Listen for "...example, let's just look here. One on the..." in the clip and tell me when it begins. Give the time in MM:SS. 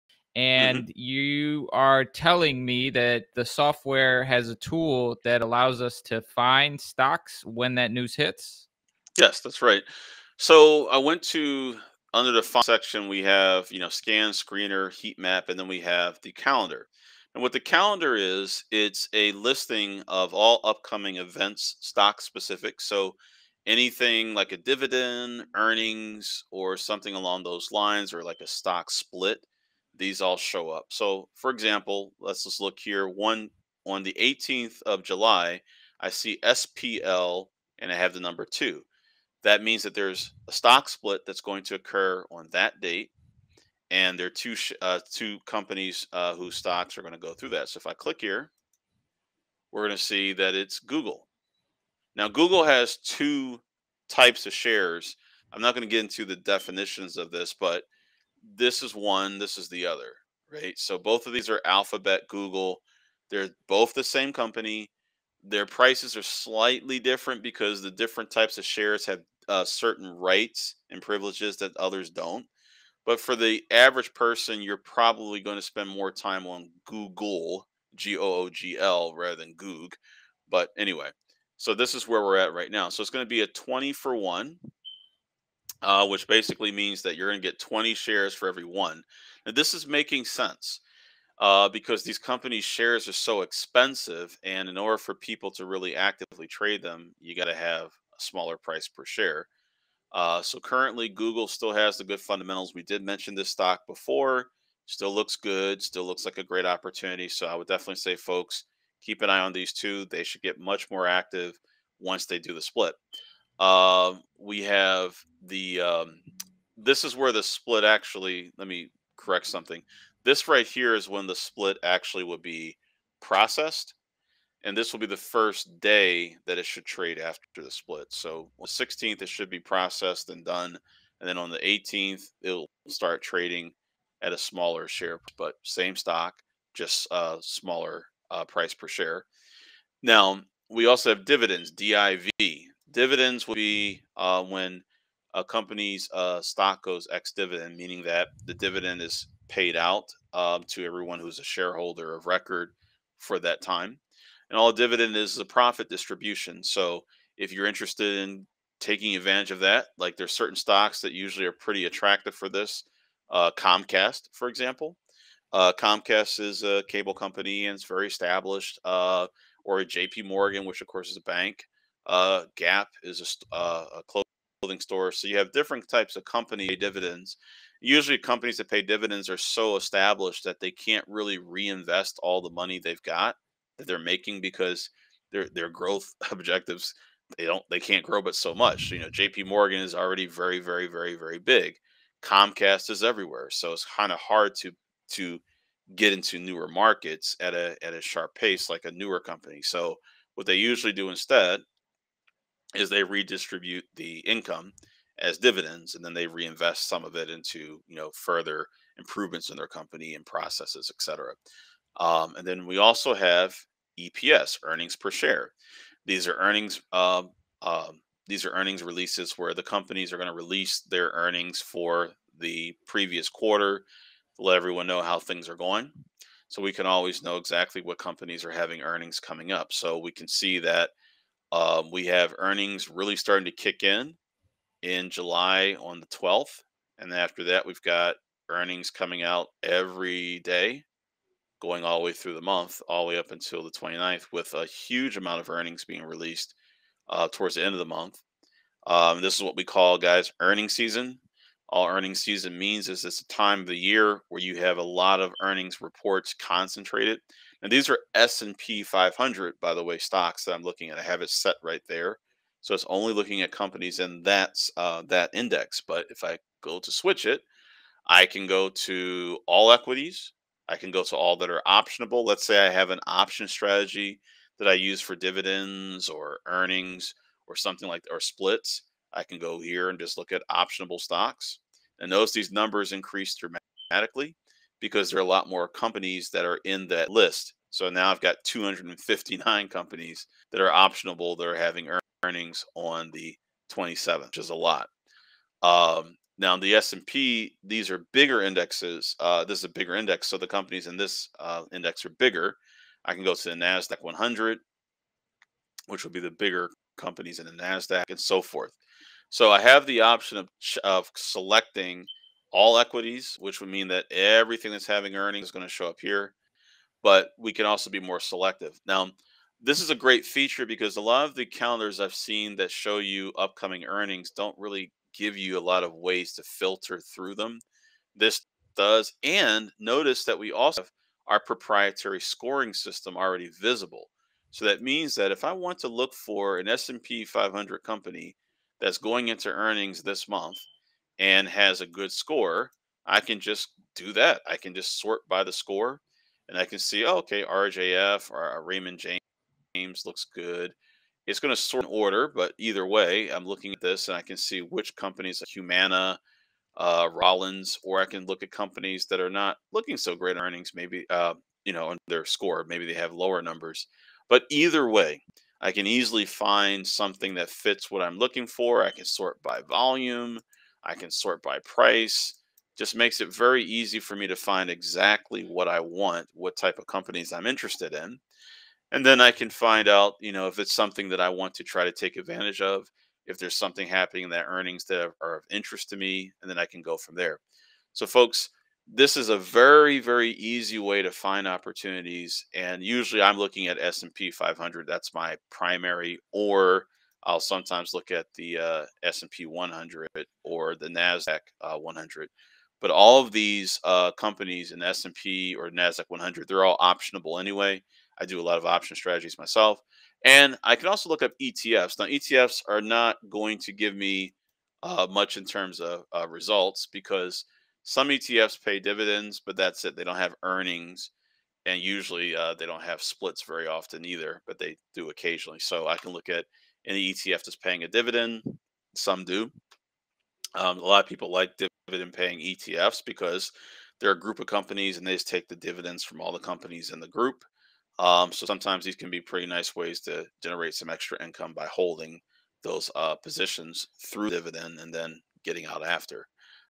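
00:31.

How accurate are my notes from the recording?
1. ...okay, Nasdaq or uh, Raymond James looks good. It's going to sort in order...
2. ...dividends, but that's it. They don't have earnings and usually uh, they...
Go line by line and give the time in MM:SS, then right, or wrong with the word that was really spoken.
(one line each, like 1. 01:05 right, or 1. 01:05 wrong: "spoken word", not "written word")
1. 05:47 wrong: "RJF", not "Nasdaq"
2. 06:58 right.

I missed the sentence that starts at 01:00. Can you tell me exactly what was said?
So both of these are Alphabet, Google.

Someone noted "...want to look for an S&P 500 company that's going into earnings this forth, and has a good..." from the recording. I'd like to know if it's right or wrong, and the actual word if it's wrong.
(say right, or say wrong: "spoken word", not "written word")
wrong: "month", not "forth".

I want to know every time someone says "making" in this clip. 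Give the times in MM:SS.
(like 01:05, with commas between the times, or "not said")
01:29, 03:03.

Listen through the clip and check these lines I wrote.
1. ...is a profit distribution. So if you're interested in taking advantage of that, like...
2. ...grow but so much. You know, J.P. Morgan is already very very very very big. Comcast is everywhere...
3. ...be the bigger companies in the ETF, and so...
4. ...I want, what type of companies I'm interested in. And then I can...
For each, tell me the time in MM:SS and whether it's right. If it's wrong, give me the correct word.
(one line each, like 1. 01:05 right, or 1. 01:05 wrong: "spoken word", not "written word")
1. 02:35 right
2. 03:08 right
3. 05:06 wrong: "Nasdaq", not "ETF"
4. 06:15 right.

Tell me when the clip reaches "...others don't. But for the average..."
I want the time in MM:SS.
01:11.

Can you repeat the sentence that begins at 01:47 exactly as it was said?
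So I would definitely say, folks, keep an eye on these two.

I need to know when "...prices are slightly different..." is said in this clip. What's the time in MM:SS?
01:05.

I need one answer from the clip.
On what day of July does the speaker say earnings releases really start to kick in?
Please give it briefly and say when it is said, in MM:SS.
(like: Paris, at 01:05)
12th, at 03:56.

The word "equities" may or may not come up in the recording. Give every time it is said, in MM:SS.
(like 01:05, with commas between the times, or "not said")
04:29, 05:12.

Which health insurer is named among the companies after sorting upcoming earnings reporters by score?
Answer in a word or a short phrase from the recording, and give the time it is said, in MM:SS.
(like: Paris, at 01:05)
Humana, at 05:55.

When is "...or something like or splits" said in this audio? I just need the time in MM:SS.
04:37.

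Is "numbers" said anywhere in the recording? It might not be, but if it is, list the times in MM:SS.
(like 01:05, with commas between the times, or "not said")
00:38, 04:42, 06:03.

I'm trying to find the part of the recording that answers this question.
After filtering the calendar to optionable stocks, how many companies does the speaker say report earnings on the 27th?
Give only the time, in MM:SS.
04:48.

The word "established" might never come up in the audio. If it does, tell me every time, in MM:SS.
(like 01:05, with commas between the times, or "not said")
02:48, 02:59.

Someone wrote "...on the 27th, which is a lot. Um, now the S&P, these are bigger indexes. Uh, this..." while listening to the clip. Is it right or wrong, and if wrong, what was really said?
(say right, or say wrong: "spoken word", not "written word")
right.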